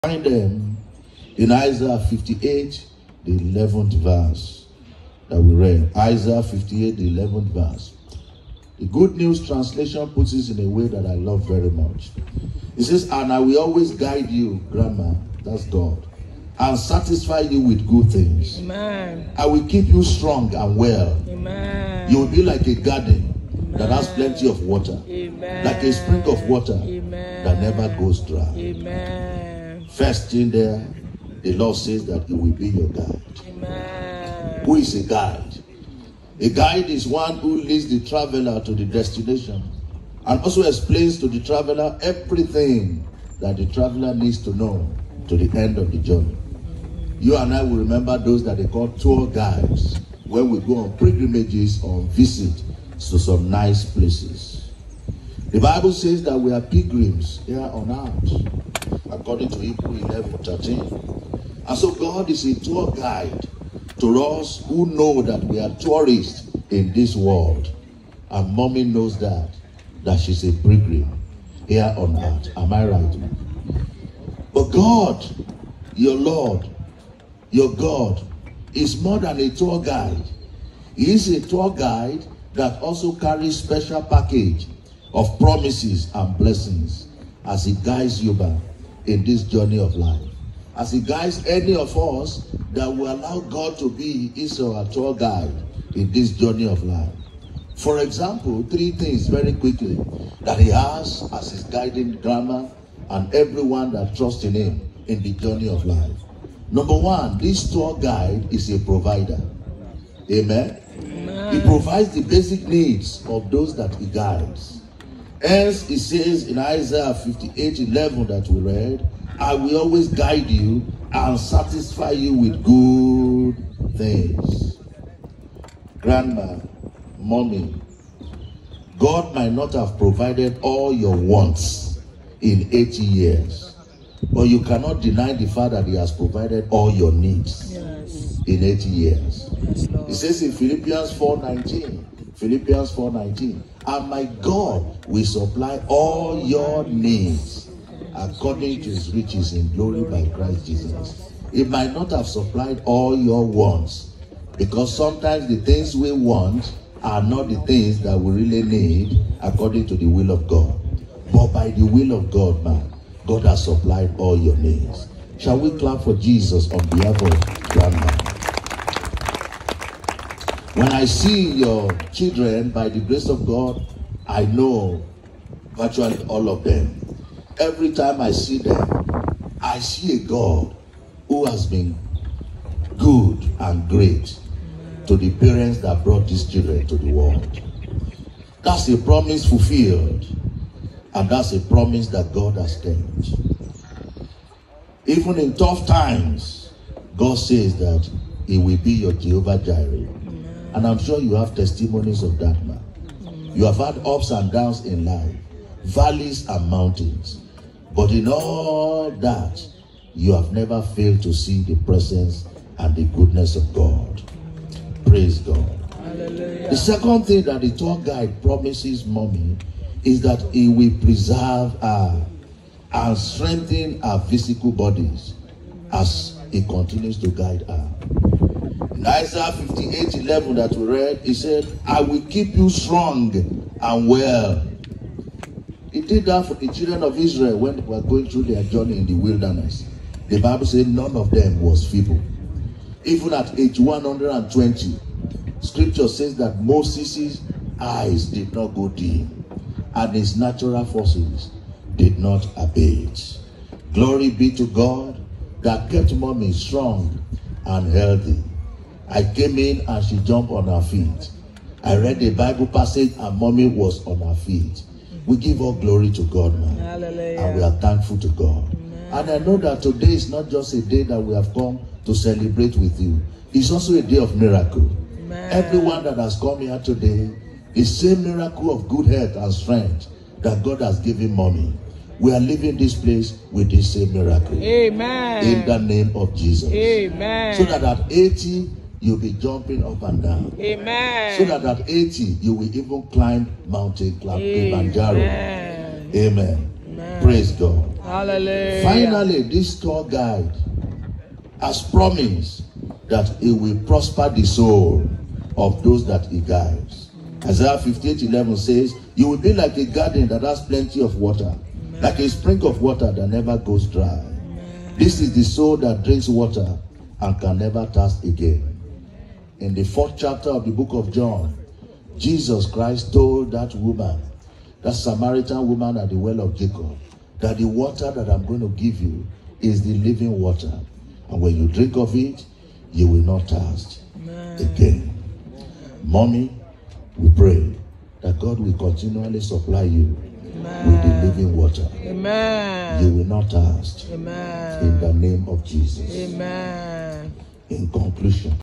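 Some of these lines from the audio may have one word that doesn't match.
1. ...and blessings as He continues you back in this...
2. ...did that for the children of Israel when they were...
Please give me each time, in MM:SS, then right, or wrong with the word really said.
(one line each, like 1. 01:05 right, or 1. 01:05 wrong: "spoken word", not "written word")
1. 01:26 wrong: "guides", not "continues"
2. 03:56 right.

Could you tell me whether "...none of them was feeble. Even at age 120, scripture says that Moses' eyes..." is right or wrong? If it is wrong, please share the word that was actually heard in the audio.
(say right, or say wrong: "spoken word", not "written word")
right.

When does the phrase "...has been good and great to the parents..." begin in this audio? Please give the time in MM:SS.
03:01.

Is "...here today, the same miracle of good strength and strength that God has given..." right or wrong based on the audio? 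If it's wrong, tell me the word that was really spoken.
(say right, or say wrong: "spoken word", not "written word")
wrong: "health", not "strength".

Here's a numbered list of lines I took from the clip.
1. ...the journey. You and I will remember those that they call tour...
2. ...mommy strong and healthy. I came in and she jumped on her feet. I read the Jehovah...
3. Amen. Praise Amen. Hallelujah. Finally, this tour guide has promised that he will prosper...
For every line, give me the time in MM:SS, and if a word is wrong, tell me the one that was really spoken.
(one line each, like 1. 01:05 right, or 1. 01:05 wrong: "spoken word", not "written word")
1. 00:45 right
2. 04:16 wrong: "Bible", not "Jehovah"
3. 04:56 wrong: "God", not "Amen".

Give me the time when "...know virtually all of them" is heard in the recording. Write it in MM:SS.
02:54.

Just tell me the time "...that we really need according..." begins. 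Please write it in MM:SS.
02:38.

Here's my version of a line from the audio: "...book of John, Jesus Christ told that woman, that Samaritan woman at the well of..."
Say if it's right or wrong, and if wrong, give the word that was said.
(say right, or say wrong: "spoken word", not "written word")
right.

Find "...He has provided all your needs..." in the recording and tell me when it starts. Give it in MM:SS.
02:15.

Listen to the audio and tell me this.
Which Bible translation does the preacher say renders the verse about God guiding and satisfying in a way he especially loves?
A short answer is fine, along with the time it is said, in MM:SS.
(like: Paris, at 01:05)
Good News Translation, at 00:08.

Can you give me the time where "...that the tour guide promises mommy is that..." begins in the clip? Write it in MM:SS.
03:37.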